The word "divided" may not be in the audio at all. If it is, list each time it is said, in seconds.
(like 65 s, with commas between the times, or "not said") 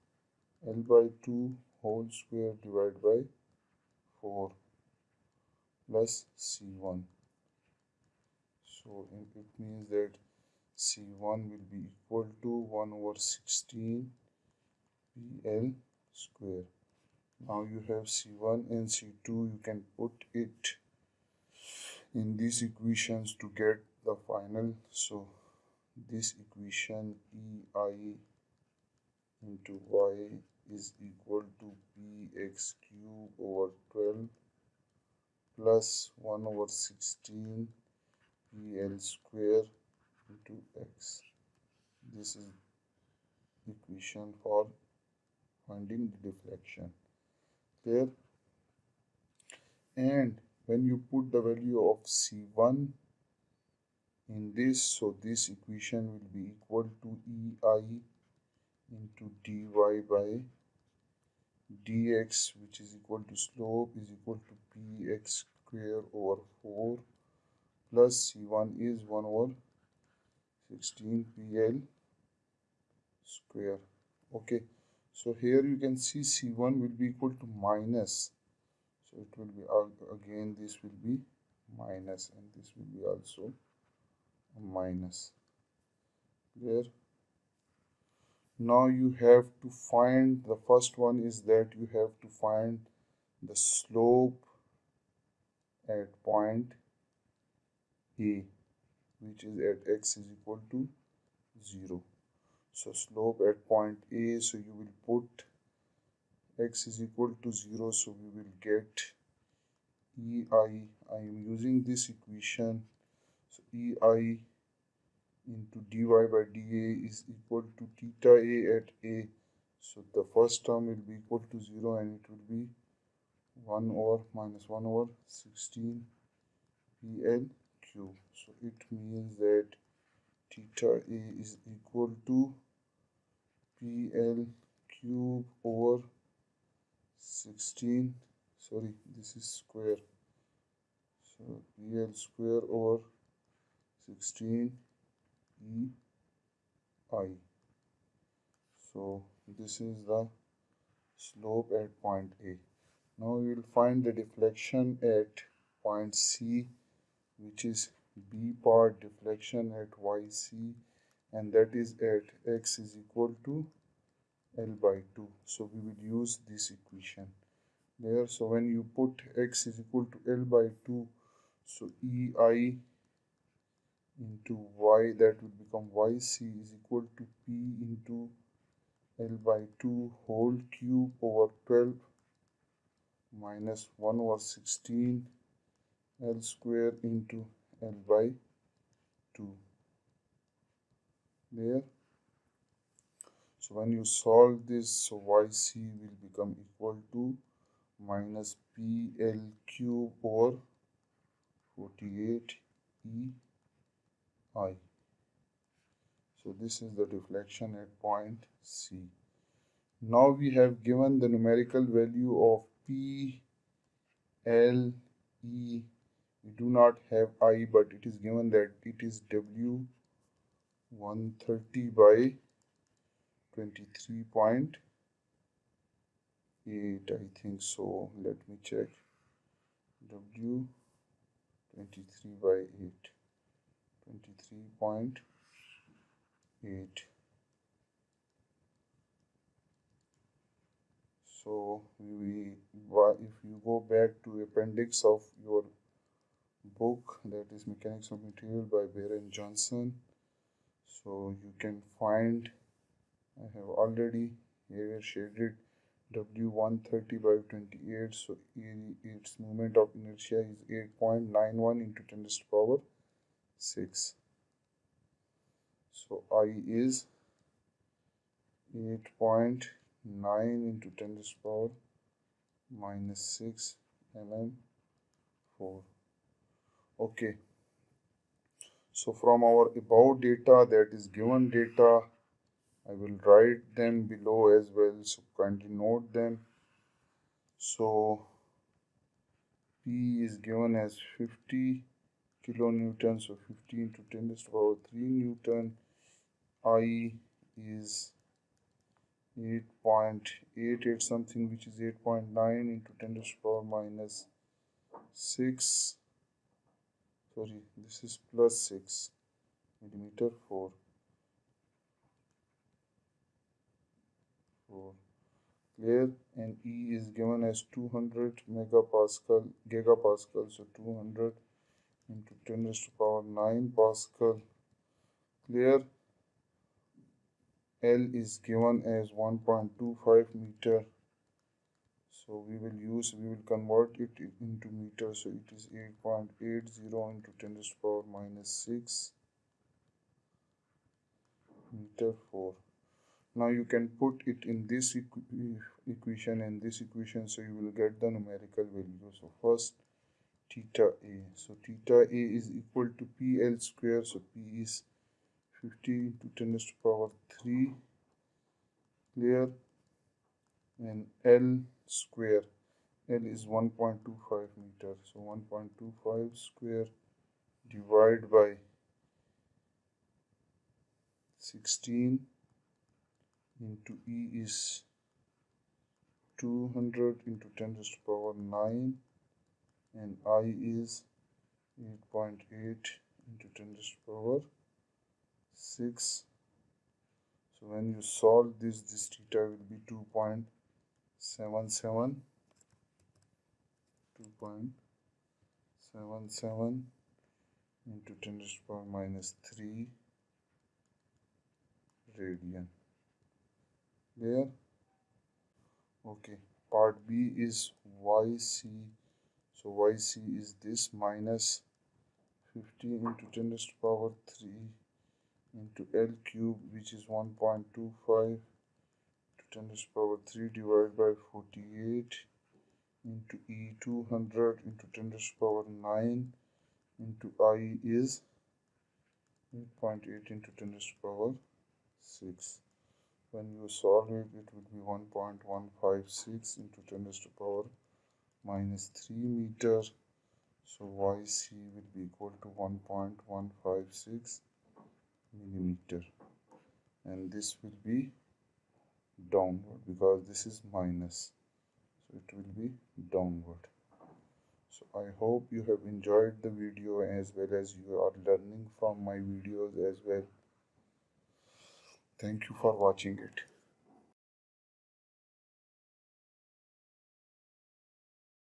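2 s, 367 s, 420 s.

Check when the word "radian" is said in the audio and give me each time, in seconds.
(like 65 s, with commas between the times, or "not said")
402 s.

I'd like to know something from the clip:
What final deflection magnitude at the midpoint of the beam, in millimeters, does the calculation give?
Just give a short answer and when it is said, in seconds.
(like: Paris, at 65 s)
1.156 mm, at 442 s.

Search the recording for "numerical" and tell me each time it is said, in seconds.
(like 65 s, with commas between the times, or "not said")
211 s, 348 s.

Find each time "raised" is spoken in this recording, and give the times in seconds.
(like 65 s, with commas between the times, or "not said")
322 s, 337 s, 413 s, 419 s, 425 s, 430 s.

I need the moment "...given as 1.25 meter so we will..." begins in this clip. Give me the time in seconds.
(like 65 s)
328 s.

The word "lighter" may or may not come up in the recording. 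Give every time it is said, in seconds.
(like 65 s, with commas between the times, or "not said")
not said.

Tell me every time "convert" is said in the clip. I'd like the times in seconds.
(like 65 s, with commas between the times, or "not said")
333 s.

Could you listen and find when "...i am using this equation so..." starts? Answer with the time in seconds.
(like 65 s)
111 s.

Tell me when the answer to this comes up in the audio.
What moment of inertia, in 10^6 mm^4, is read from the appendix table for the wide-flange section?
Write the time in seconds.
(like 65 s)
261 s.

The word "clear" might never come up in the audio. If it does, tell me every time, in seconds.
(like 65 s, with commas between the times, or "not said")
315 s, 325 s, 359 s.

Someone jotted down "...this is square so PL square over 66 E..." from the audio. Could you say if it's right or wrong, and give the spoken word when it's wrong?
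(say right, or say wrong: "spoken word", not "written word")
wrong: "16", not "66".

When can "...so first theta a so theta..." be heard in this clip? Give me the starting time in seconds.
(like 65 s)
349 s.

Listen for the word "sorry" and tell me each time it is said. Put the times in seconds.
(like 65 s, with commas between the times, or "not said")
138 s, 307 s.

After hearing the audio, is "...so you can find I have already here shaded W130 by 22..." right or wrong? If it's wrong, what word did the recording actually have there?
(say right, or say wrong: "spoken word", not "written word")
wrong: "28", not "22".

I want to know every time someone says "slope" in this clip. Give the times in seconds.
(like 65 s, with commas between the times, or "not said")
63 s, 93 s, 102 s, 151 s.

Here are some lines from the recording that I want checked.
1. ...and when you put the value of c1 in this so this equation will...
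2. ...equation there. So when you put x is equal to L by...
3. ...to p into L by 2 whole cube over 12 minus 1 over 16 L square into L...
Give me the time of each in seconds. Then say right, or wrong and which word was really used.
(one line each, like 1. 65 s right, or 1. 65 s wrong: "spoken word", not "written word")
1. 49 s right
2. 166 s right
3. 177 s right.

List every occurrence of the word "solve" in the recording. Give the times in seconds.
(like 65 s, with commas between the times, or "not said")
194 s, 388 s, 433 s.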